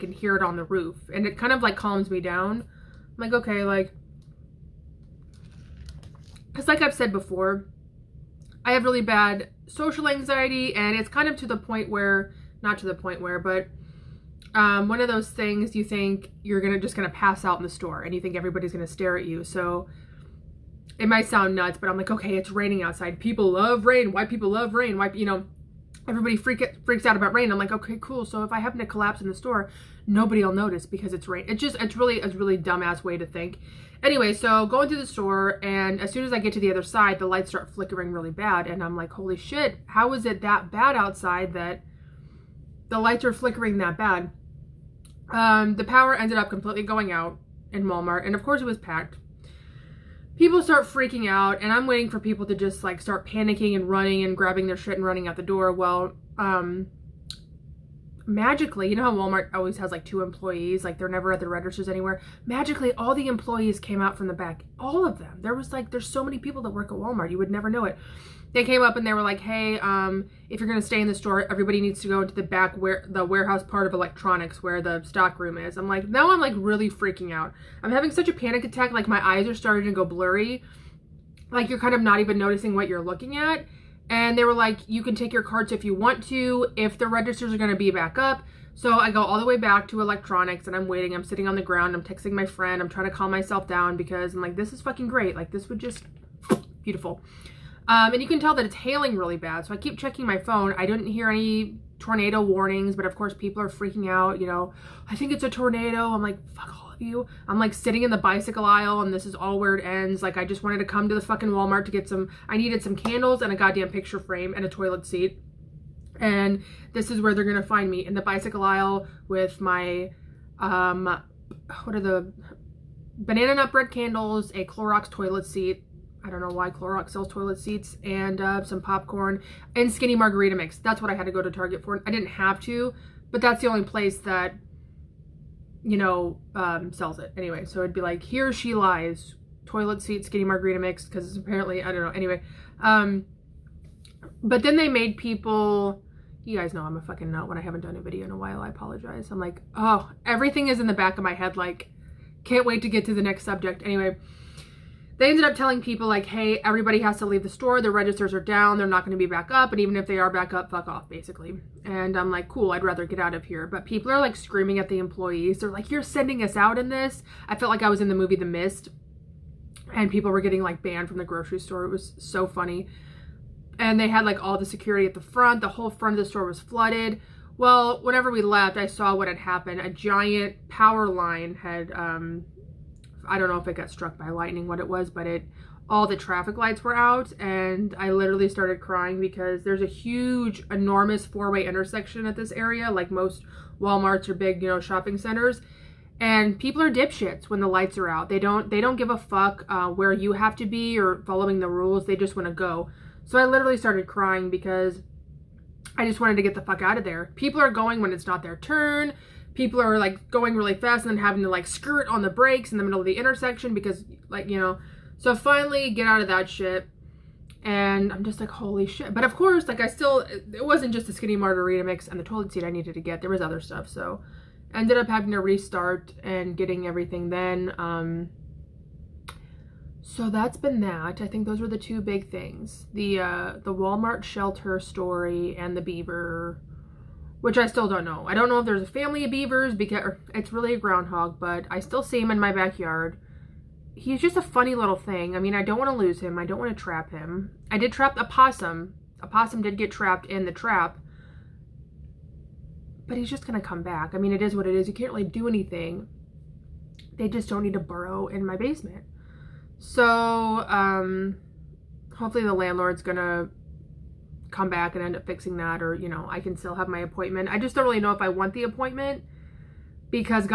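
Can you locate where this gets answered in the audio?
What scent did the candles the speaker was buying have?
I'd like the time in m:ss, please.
2:03.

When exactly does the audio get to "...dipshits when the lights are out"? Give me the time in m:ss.
3:16.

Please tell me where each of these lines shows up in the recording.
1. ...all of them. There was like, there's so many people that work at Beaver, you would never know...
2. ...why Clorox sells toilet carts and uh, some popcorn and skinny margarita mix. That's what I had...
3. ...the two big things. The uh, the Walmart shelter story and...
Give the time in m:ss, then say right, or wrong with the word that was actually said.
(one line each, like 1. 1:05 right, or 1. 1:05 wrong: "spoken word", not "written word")
1. 1:04 wrong: "Walmart", not "Beaver"
2. 2:06 wrong: "seats", not "carts"
3. 3:51 right.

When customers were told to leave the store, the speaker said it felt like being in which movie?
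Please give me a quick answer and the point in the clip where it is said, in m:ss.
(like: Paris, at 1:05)
The Mist, at 2:48.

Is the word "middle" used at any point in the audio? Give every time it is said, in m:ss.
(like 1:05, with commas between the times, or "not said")
3:32.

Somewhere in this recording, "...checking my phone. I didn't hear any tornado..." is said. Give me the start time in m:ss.
1:39.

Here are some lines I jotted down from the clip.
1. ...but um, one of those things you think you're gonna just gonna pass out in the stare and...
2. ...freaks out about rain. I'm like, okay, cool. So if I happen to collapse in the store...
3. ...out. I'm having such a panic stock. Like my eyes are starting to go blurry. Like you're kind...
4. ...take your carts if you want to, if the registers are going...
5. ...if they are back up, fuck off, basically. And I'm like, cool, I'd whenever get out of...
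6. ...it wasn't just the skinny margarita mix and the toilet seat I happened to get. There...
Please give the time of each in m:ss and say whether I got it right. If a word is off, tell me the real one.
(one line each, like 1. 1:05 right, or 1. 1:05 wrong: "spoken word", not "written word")
1. 0:13 wrong: "store", not "stare"
2. 0:26 right
3. 1:17 wrong: "attack", not "stock"
4. 1:25 right
5. 2:39 wrong: "rather", not "whenever"
6. 3:40 wrong: "needed", not "happened".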